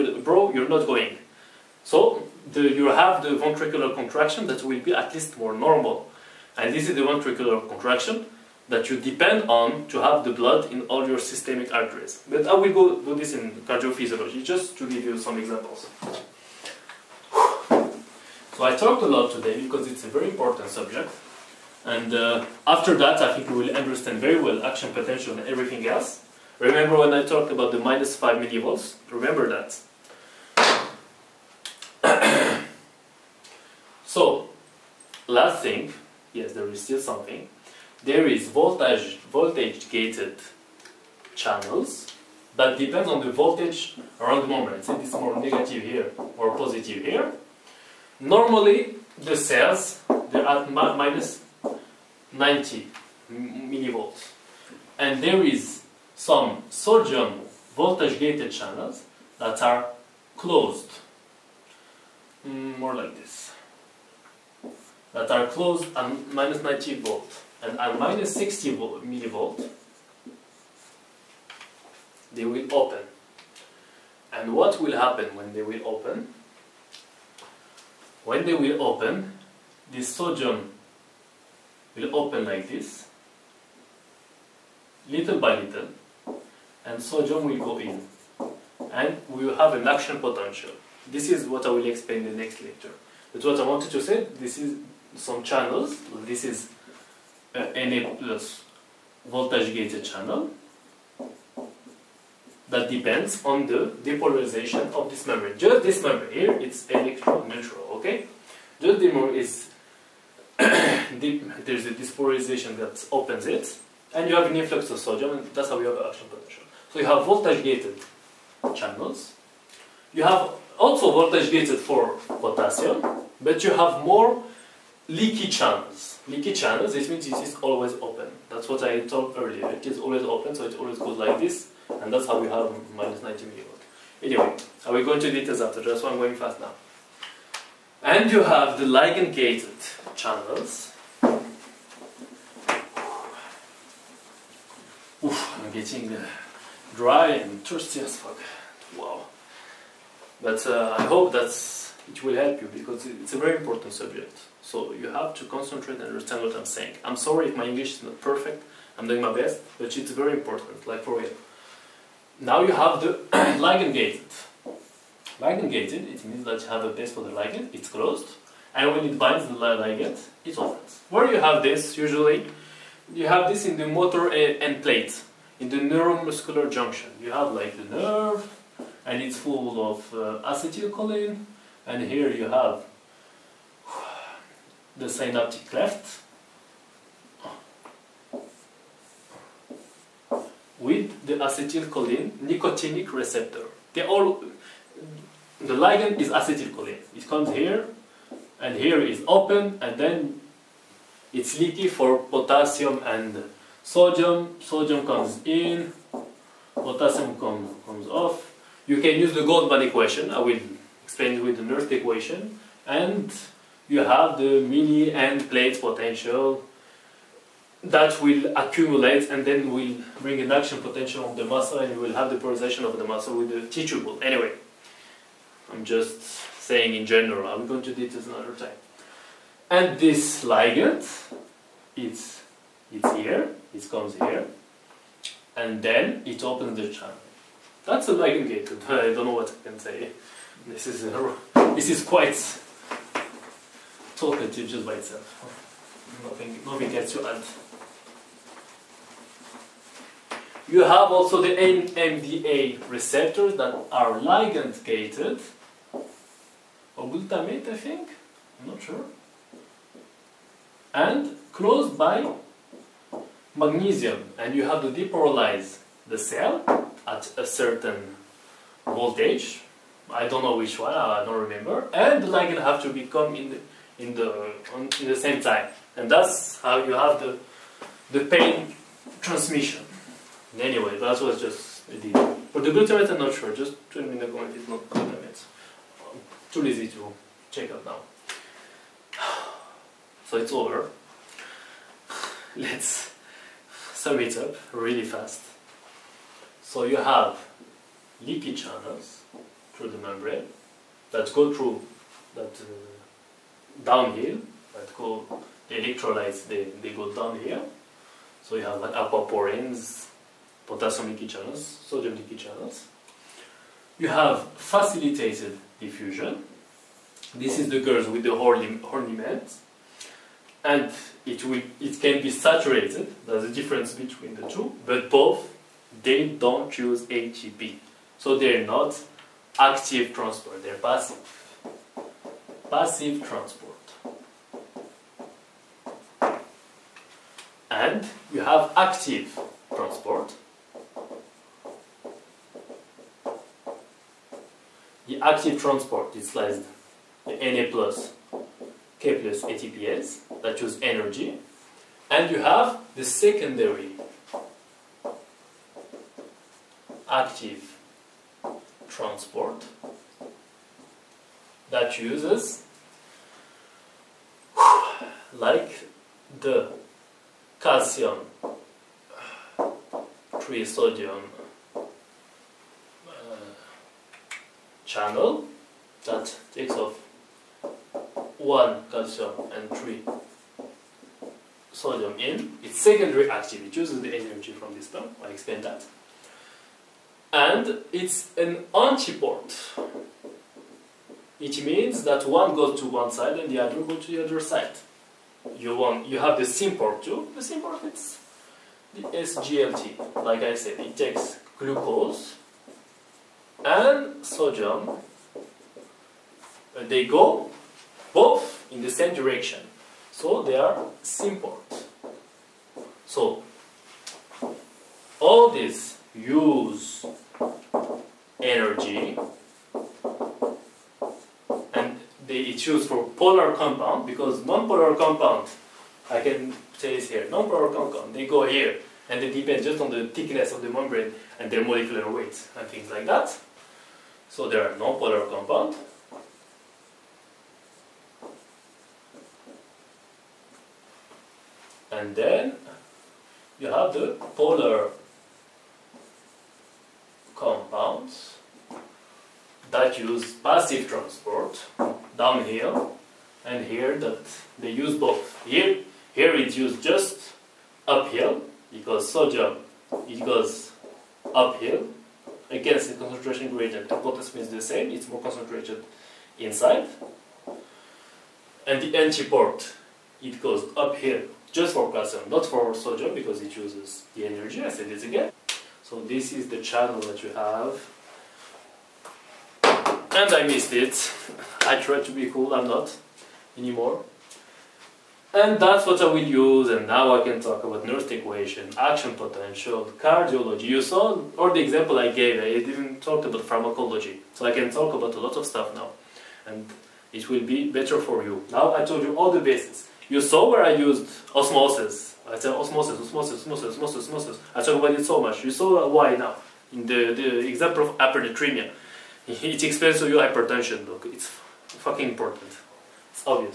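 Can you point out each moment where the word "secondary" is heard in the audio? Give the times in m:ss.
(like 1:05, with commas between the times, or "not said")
5:53, 6:22.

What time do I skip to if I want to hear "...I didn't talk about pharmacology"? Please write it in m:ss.
8:12.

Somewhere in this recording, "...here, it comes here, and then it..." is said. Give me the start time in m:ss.
3:53.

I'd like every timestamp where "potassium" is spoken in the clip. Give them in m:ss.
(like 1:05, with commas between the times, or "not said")
2:02, 3:22, 3:26, 5:10.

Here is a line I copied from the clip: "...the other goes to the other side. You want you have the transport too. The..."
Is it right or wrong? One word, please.
wrong.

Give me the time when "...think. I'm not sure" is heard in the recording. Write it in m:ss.
4:17.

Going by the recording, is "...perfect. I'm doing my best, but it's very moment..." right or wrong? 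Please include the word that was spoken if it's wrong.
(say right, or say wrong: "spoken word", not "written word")
wrong: "important", not "moment".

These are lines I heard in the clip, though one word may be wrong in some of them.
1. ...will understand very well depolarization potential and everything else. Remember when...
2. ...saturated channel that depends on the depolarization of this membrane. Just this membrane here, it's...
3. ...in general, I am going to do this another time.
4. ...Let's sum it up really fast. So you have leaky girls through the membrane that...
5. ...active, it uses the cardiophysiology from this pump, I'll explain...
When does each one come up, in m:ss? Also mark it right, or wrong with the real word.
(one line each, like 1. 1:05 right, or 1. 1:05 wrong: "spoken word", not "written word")
1. 0:23 wrong: "action", not "depolarization"
2. 1:39 wrong: "gated", not "saturated"
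3. 3:46 right
4. 4:52 wrong: "channels", not "girls"
5. 6:23 wrong: "energy", not "cardiophysiology".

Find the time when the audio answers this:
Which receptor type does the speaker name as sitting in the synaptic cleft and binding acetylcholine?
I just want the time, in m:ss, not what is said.
3:11.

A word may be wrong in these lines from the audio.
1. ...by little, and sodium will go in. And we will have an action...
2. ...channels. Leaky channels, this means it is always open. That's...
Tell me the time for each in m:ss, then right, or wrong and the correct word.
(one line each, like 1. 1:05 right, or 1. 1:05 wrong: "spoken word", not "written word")
1. 1:25 right
2. 2:05 right.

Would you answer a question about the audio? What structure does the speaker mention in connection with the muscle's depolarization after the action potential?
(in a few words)
T-tubule.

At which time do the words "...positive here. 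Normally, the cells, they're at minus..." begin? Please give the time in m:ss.
0:46.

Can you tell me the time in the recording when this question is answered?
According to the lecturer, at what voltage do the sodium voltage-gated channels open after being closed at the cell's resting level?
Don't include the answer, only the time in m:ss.
1:07.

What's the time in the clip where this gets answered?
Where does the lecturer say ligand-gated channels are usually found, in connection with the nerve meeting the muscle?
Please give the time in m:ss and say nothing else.
2:53.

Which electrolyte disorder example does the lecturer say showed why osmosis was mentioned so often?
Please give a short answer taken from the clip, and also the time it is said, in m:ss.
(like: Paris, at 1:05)
hypernatremia, at 8:27.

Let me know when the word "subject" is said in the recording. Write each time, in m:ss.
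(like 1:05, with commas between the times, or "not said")
0:20, 2:33.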